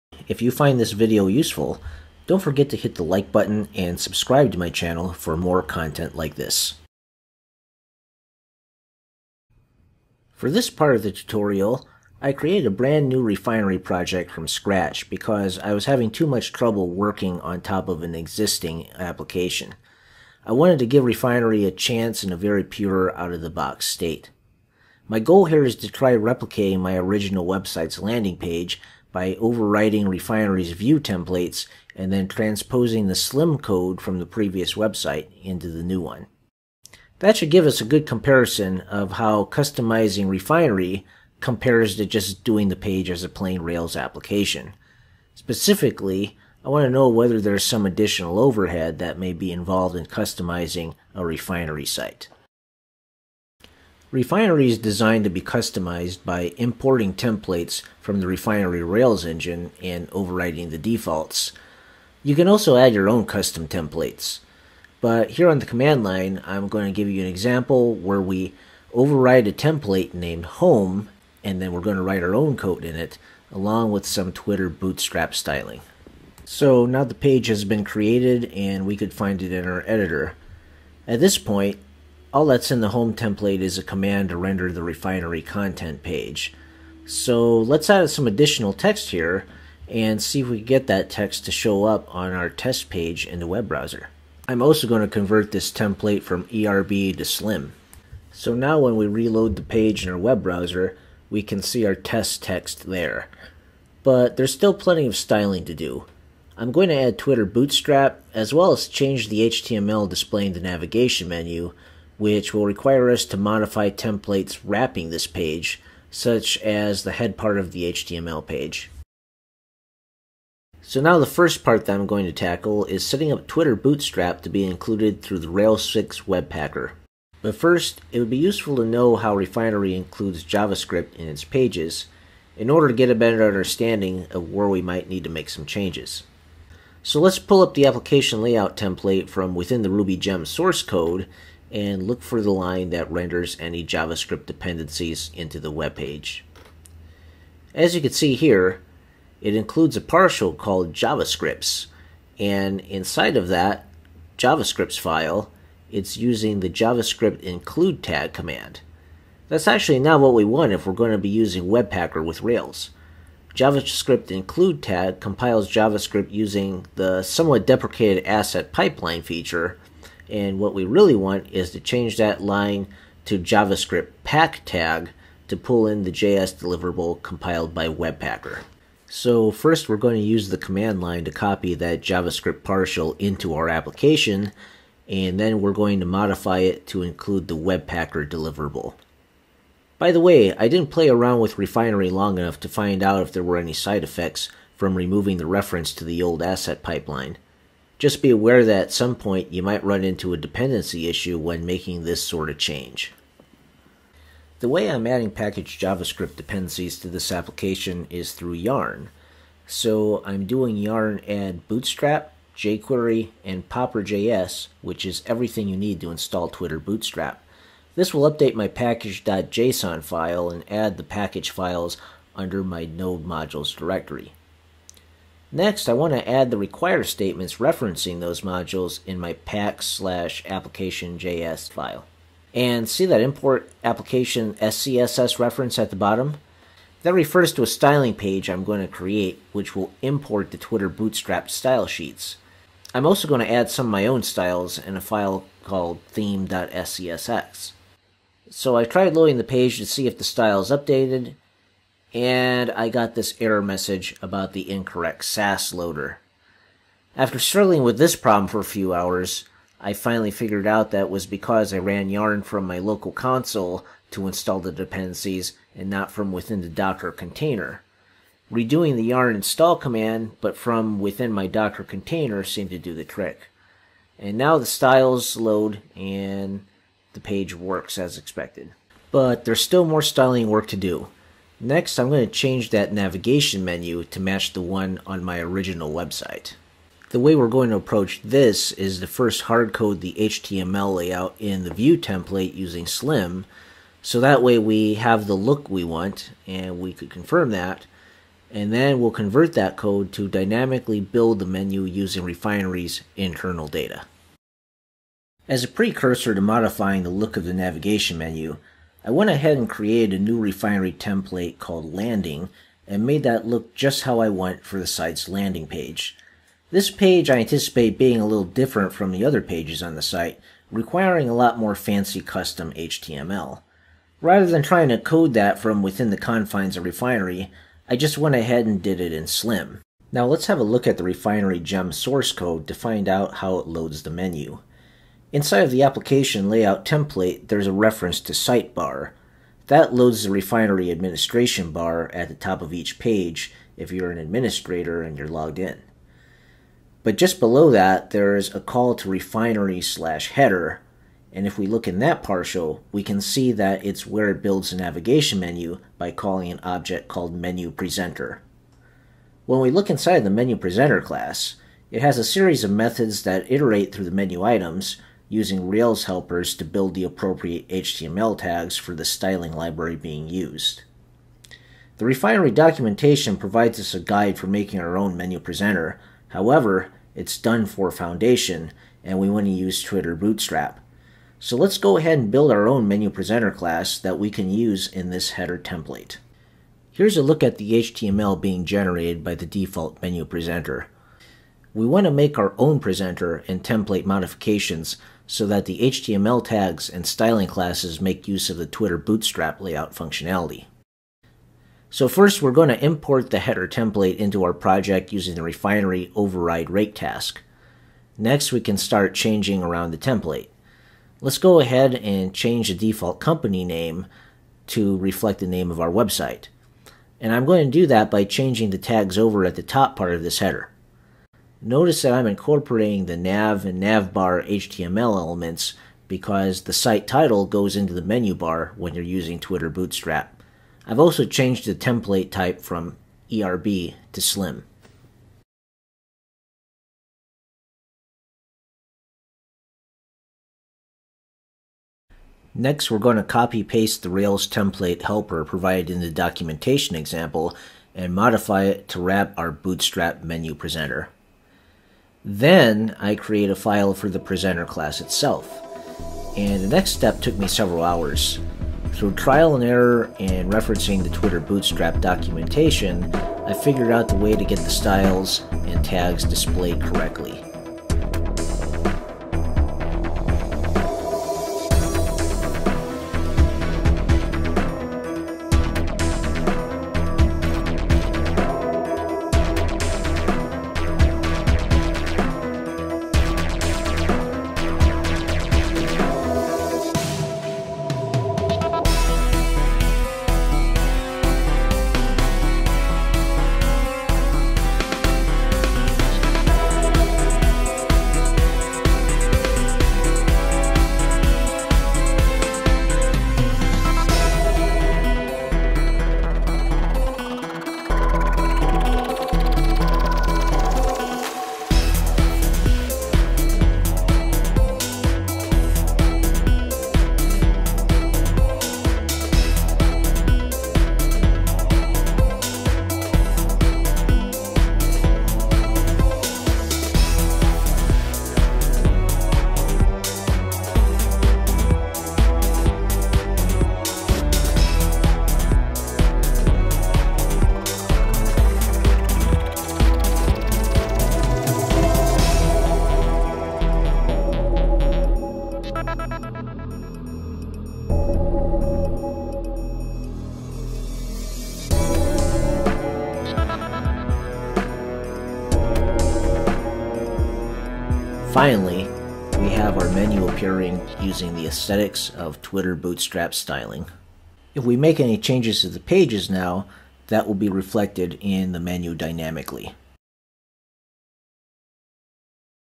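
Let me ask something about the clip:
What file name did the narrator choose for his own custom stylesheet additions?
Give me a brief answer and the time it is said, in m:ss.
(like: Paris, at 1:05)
theme.scss, at 4:06.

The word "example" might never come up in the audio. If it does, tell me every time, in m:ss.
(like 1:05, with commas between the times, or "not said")
1:07, 7:26.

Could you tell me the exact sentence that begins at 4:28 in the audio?
Redoing the yarn install command, but from within my Docker container seemed to do the trick.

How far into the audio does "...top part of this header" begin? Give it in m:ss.
6:59.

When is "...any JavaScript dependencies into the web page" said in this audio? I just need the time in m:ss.
2:23.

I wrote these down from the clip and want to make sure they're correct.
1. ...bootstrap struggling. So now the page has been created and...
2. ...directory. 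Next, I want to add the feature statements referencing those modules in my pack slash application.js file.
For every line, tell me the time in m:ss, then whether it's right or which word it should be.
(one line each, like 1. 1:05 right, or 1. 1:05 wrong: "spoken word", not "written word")
1. 1:14 wrong: "styling", not "struggling"
2. 3:43 wrong: "require", not "feature".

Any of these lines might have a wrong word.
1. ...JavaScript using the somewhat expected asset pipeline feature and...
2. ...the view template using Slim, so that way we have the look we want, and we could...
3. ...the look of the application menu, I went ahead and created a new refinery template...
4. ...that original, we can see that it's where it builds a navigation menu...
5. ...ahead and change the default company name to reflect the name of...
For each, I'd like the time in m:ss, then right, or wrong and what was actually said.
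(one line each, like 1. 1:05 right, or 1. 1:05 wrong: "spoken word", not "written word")
1. 2:45 wrong: "deprecated", not "expected"
2. 4:51 right
3. 5:07 wrong: "navigation", not "application"
4. 5:51 wrong: "partial", not "original"
5. 6:51 right.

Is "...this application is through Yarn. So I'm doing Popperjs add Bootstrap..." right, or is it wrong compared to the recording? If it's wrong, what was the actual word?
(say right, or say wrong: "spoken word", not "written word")
wrong: "Yarn", not "Popperjs".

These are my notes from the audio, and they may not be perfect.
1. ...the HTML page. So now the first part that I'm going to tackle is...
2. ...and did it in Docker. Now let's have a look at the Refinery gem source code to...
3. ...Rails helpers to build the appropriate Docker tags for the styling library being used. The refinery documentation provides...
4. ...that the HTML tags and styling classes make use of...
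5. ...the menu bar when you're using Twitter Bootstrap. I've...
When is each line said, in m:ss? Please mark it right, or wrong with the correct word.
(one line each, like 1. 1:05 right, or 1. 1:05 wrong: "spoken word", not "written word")
1. 1:57 right
2. 5:28 wrong: "Slim", not "Docker"
3. 6:05 wrong: "HTML", not "Docker"
4. 6:35 right
5. 7:07 right.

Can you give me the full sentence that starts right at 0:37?
That should give us a good comparison of how customizing Refinery compares to just doing the page as a plain Rails application.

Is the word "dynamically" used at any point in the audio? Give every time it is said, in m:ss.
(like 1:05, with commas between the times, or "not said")
5:00, 9:28.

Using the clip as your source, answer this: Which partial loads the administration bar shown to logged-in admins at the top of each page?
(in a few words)
Sitebar.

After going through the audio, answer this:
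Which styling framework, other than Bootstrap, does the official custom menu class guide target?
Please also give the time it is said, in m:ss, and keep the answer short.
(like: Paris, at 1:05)
Foundation, at 6:17.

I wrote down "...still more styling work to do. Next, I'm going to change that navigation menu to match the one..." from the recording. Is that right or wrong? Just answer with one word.
right.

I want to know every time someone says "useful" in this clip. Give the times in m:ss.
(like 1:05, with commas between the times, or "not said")
0:01, 2:08.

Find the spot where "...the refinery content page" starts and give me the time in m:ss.
1:24.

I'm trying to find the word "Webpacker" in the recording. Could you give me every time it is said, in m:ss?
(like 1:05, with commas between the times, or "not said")
2:06, 2:41, 2:57, 3:07.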